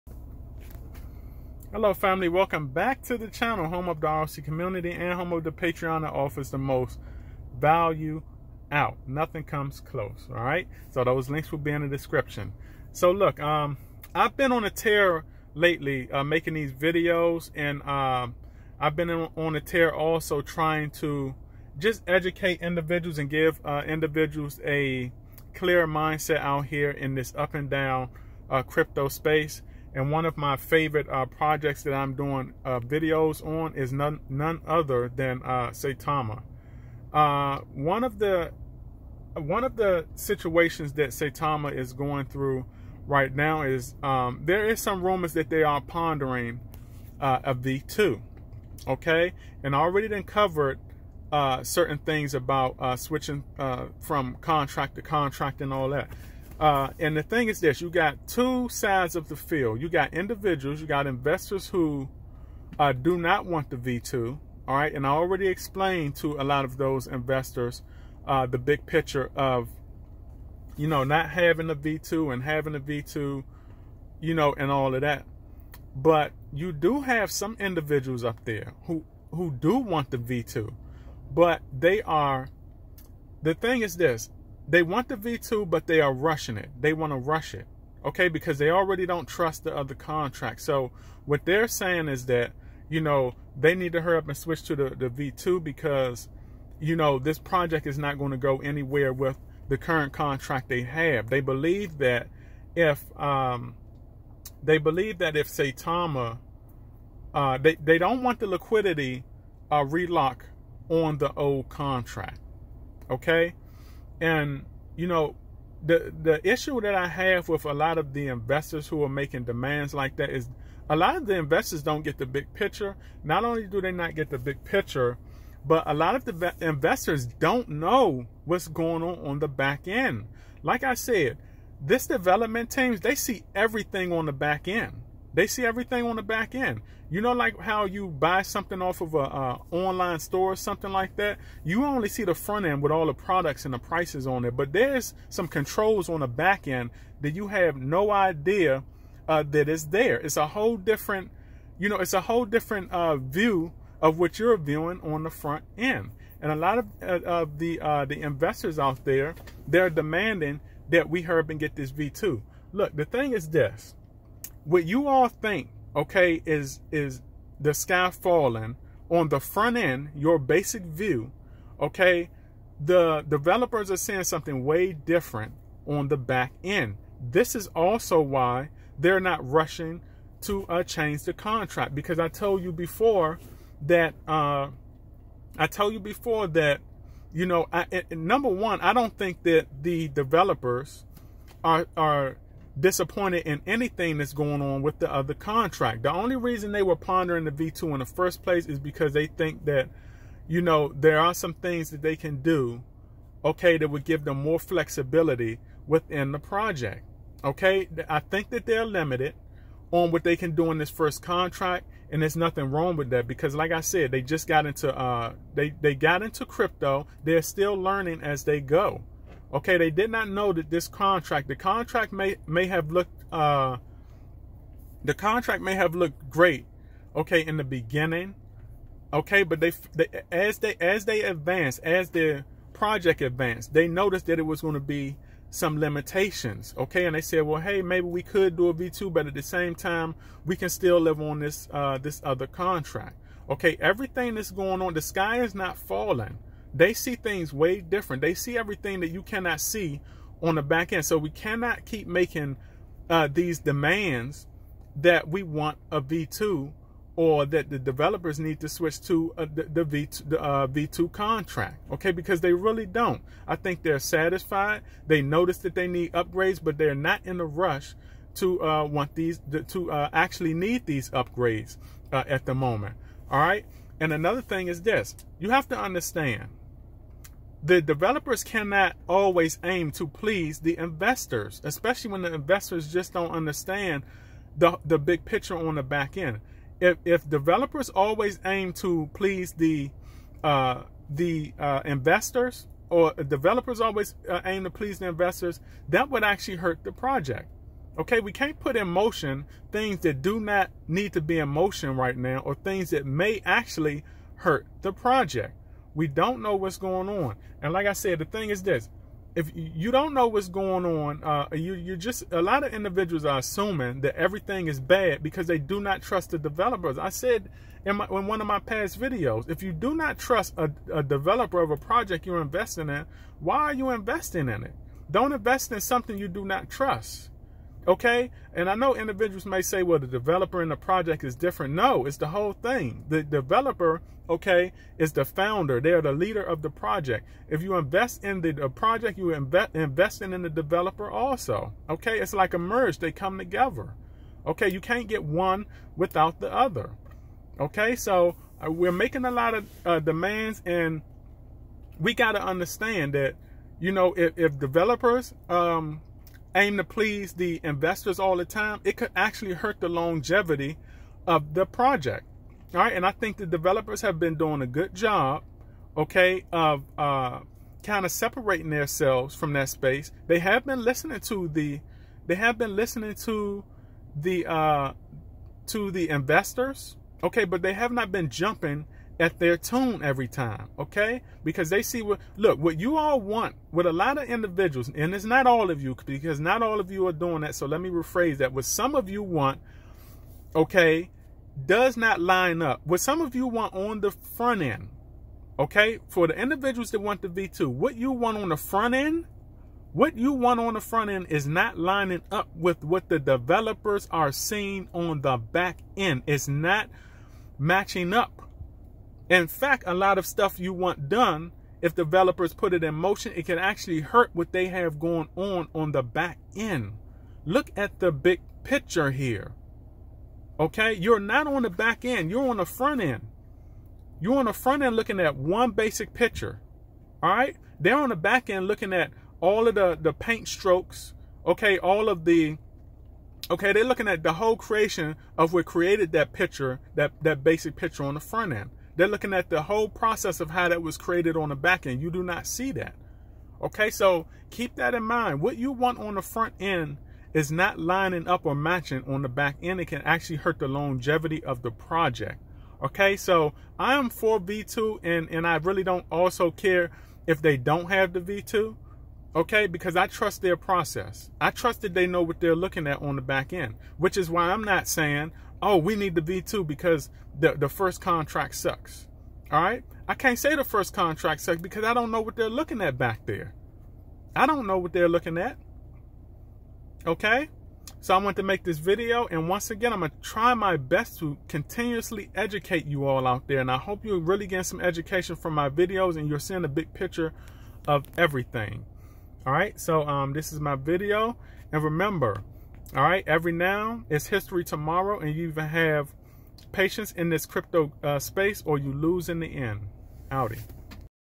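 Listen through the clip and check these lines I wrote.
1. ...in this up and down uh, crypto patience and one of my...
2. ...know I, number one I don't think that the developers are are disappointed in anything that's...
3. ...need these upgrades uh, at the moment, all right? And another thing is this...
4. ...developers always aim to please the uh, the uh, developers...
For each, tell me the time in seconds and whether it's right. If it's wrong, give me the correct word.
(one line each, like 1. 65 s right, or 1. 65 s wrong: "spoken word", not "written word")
1. 26 s wrong: "space", not "patience"
2. 187 s right
3. 270 s right
4. 287 s wrong: "investors", not "developers".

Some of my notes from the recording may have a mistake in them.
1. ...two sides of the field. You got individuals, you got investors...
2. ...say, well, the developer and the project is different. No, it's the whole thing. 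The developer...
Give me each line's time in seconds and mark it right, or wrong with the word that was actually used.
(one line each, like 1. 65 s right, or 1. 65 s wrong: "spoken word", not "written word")
1. 58 s right
2. 329 s right.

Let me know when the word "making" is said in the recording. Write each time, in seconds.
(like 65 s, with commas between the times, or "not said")
16 s, 119 s, 252 s, 348 s.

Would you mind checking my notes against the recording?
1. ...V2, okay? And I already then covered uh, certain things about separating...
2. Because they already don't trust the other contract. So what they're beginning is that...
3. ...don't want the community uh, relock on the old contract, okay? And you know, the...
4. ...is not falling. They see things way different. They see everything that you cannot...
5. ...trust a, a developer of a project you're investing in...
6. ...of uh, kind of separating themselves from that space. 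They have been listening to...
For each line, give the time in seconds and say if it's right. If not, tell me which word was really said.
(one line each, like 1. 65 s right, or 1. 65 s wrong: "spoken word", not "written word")
1. 47 s wrong: "switching", not "separating"
2. 88 s wrong: "saying", not "beginning"
3. 107 s wrong: "liquidity", not "community"
4. 245 s right
5. 320 s right
6. 366 s right.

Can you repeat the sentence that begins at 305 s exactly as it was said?
We don't know what's going on.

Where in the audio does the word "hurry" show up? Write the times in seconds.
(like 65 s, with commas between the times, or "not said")
94 s, 161 s.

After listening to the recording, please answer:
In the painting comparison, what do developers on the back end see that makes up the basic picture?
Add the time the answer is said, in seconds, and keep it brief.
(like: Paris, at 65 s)
paint strokes, at 430 s.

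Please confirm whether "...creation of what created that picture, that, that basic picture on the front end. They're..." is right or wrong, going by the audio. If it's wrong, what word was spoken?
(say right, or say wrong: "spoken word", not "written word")
right.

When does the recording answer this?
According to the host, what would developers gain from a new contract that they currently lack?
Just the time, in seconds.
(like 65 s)
204 s.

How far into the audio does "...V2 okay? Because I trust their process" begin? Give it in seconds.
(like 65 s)
458 s.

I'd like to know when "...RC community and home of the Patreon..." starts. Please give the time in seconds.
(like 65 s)
4 s.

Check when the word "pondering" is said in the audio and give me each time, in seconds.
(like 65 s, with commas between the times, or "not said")
45 s, 196 s.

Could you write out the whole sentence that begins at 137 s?
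You know, like how you buy something off of a online store or something like that.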